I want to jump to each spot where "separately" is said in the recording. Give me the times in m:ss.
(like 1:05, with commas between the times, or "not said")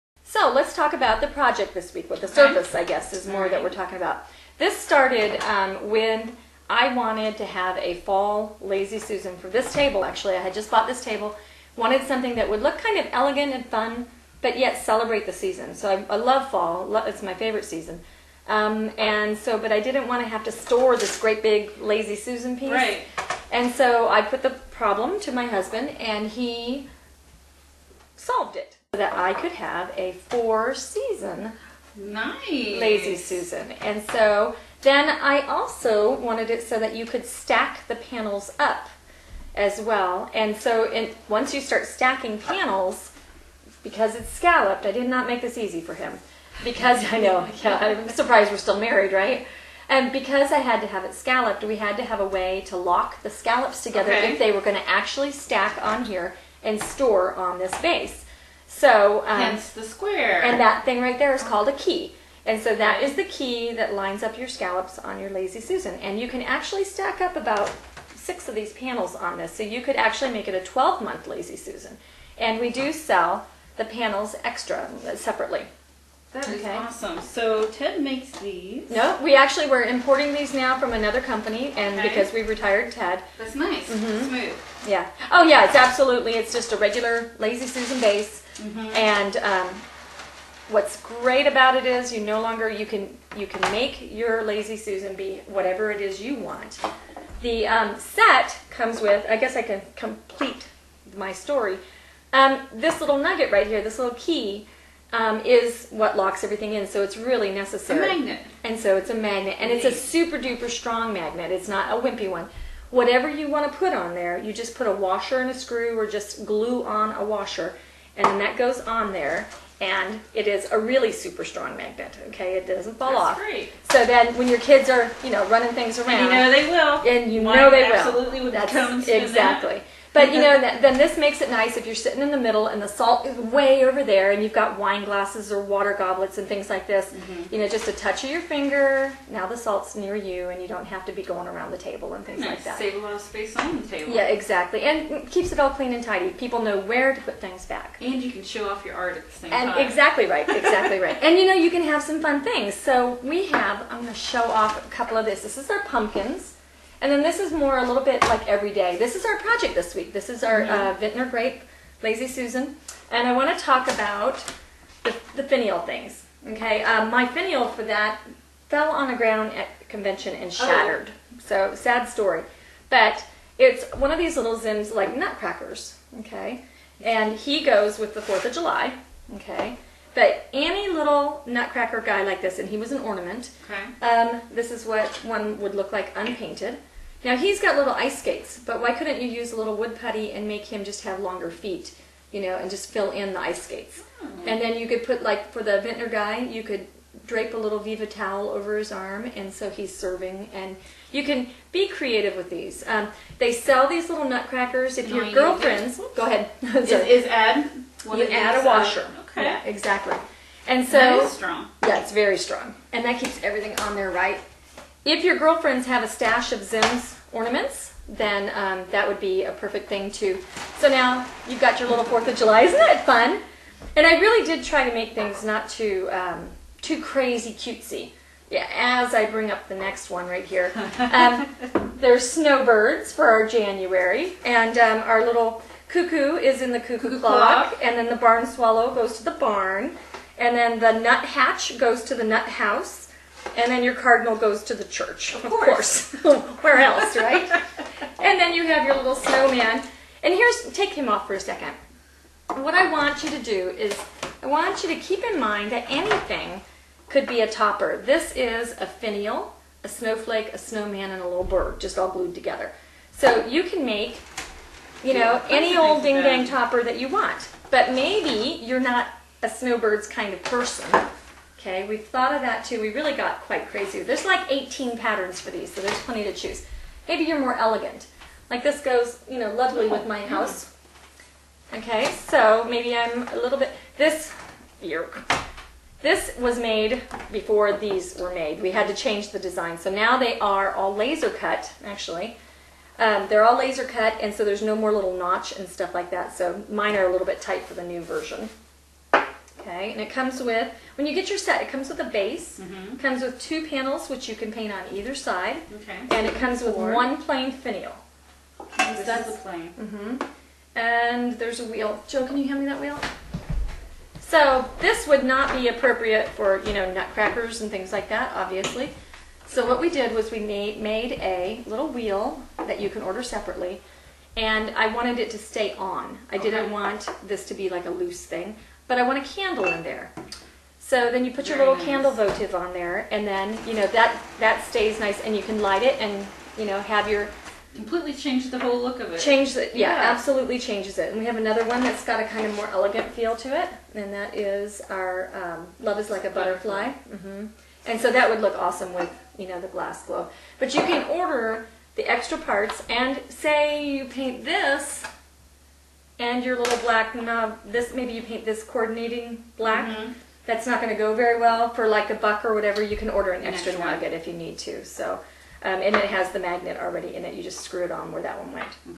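1:15, 5:23.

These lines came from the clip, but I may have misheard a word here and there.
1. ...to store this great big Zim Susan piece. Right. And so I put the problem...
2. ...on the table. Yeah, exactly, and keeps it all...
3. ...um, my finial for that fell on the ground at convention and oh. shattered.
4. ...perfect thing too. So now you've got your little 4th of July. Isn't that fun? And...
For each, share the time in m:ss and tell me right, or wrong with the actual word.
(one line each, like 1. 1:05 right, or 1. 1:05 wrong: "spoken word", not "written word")
1. 0:20 wrong: "Lazy", not "Zim"
2. 2:23 right
3. 2:46 right
4. 3:39 right.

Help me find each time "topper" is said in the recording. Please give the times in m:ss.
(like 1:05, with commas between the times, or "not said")
4:17, 4:26.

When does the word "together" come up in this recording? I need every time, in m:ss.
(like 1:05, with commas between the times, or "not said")
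0:53, 4:22.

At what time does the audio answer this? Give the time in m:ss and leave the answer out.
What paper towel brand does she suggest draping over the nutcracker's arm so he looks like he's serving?
3:17.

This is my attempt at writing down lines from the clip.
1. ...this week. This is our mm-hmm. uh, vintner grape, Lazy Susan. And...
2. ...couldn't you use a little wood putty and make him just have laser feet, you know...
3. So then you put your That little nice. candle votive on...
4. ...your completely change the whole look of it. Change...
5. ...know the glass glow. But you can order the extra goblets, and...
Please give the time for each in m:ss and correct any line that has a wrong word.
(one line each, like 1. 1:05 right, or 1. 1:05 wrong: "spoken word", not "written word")
1. 2:39 right
2. 3:08 wrong: "longer", not "laser"
3. 5:30 wrong: "Very", not "That"
4. 5:37 right
5. 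5:49 wrong: "parts", not "goblets".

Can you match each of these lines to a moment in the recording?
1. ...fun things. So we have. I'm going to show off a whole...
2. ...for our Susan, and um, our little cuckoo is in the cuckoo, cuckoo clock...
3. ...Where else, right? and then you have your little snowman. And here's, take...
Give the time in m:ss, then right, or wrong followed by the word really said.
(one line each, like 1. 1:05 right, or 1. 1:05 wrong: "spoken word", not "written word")
1. 2:32 wrong: "couple", not "whole"
2. 3:53 wrong: "January", not "Susan"
3. 4:06 right.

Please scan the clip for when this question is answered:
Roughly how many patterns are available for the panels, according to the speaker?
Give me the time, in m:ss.
4:34.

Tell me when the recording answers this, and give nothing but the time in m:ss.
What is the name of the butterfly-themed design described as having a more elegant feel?
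5:45.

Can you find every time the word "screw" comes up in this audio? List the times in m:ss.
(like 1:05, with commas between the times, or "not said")
1:55, 6:07.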